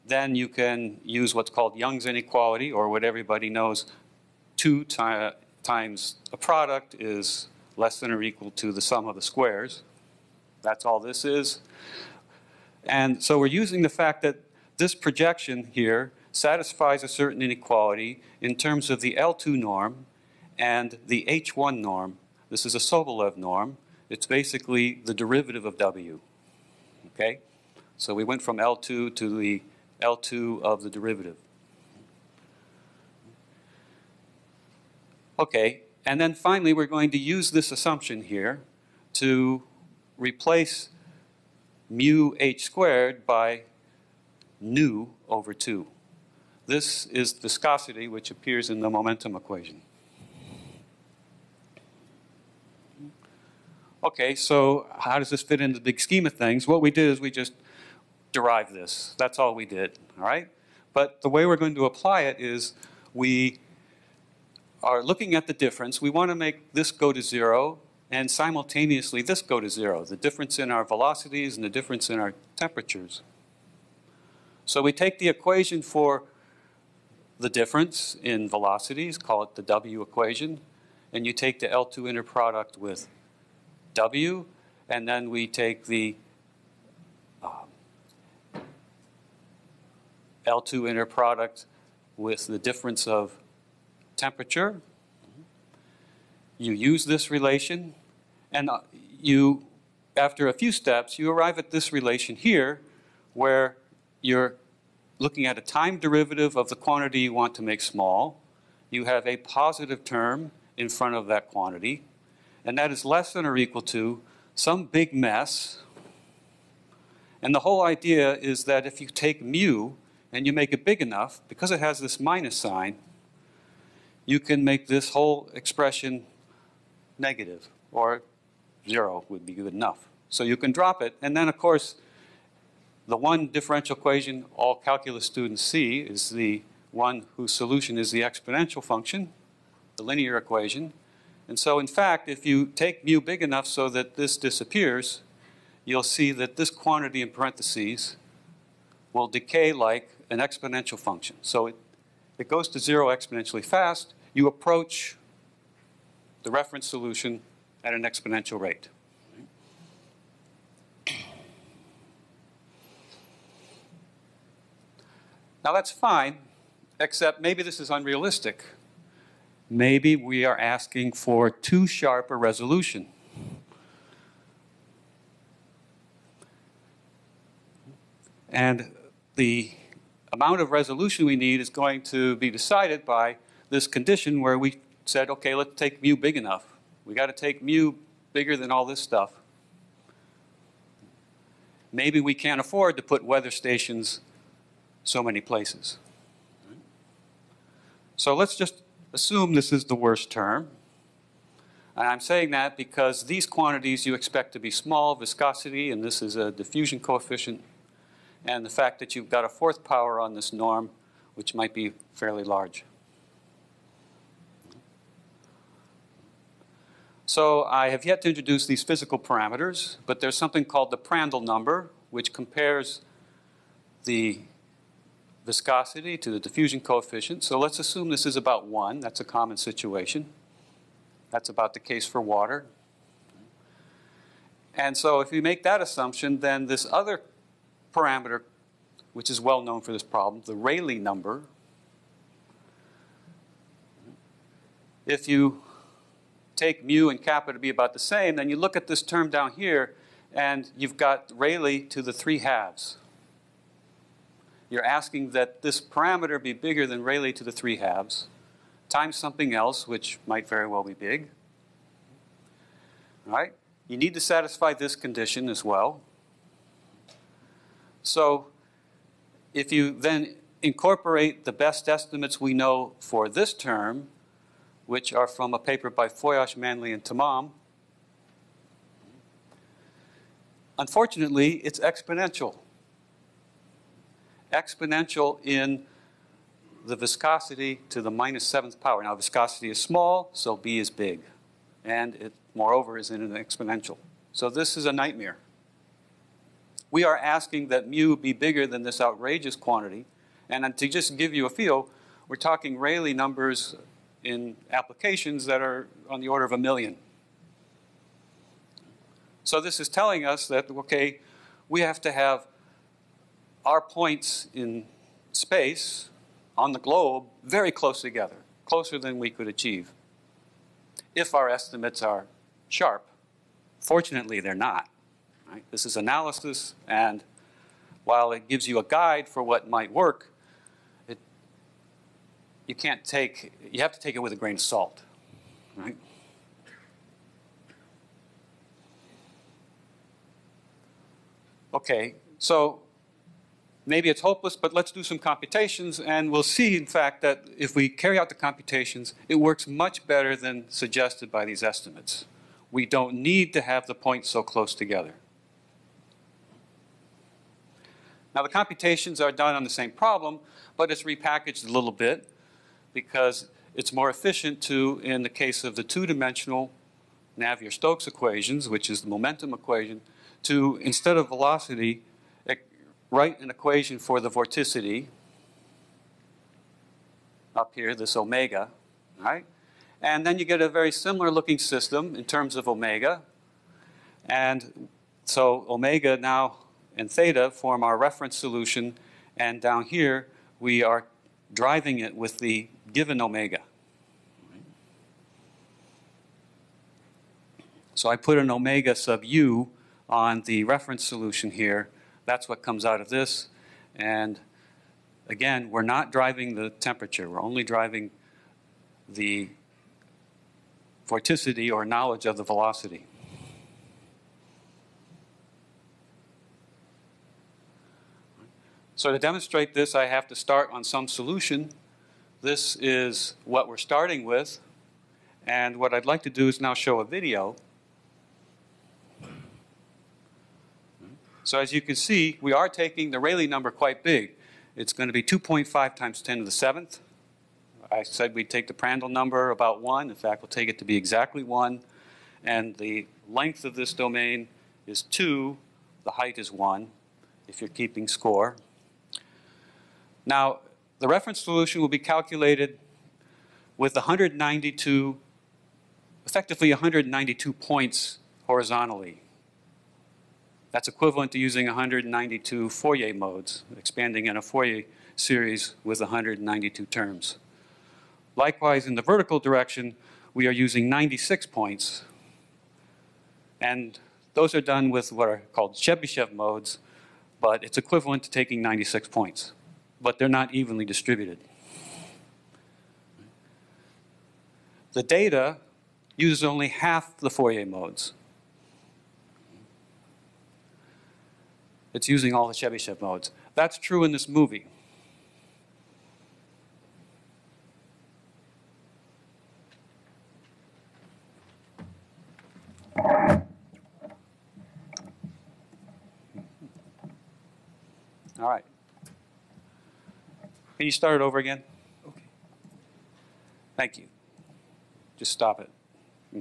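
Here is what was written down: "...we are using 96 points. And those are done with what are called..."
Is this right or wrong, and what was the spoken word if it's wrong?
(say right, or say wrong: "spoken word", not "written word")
right.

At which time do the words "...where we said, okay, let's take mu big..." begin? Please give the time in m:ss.
3:04.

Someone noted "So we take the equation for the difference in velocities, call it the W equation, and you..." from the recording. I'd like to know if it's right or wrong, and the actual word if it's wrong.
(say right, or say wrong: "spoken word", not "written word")
right.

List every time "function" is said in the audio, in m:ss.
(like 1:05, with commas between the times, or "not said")
2:18, 2:30.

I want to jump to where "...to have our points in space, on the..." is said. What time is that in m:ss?
5:12.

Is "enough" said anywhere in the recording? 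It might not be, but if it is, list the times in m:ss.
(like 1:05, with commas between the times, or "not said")
2:01, 2:09, 2:23, 3:06.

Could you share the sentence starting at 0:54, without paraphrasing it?
Okay, so how does this fit into the scheme of things?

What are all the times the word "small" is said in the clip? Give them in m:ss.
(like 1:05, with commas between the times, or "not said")
1:47, 3:24, 4:49.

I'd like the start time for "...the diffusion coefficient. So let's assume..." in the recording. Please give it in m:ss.
3:46.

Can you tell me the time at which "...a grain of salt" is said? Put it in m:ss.
5:34.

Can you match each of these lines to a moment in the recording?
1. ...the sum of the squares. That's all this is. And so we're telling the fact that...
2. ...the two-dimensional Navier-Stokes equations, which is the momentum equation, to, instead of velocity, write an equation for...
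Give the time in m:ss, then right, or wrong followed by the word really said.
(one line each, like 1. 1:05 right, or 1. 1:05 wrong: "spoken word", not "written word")
1. 0:08 wrong: "using", not "telling"
2. 6:05 right.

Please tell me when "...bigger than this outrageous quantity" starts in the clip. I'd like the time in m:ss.
4:58.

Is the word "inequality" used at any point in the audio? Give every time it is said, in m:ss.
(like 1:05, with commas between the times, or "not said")
0:02, 0:17.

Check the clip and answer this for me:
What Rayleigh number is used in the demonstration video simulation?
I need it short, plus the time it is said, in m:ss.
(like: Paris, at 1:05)
2.5 times 10^7, at 7:15.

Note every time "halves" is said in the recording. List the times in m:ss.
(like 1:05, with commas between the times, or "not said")
4:12, 4:17.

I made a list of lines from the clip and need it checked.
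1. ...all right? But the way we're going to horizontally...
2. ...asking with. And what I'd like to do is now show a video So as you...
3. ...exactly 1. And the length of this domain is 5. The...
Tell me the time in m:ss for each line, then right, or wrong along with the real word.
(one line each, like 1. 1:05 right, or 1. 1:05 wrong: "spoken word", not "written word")
1. 1:00 wrong: "apply", not "horizontally"
2. 7:03 wrong: "starting", not "asking"
3. 7:20 wrong: "2", not "5".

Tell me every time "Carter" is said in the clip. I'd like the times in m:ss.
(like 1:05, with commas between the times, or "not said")
not said.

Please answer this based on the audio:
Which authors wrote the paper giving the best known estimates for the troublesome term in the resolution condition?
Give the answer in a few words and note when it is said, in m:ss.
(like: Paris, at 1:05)
Foias, Manley, and Temam, at 4:36.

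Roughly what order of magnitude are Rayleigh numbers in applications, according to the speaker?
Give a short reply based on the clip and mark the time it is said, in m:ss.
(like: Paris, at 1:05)
A million, at 5:06.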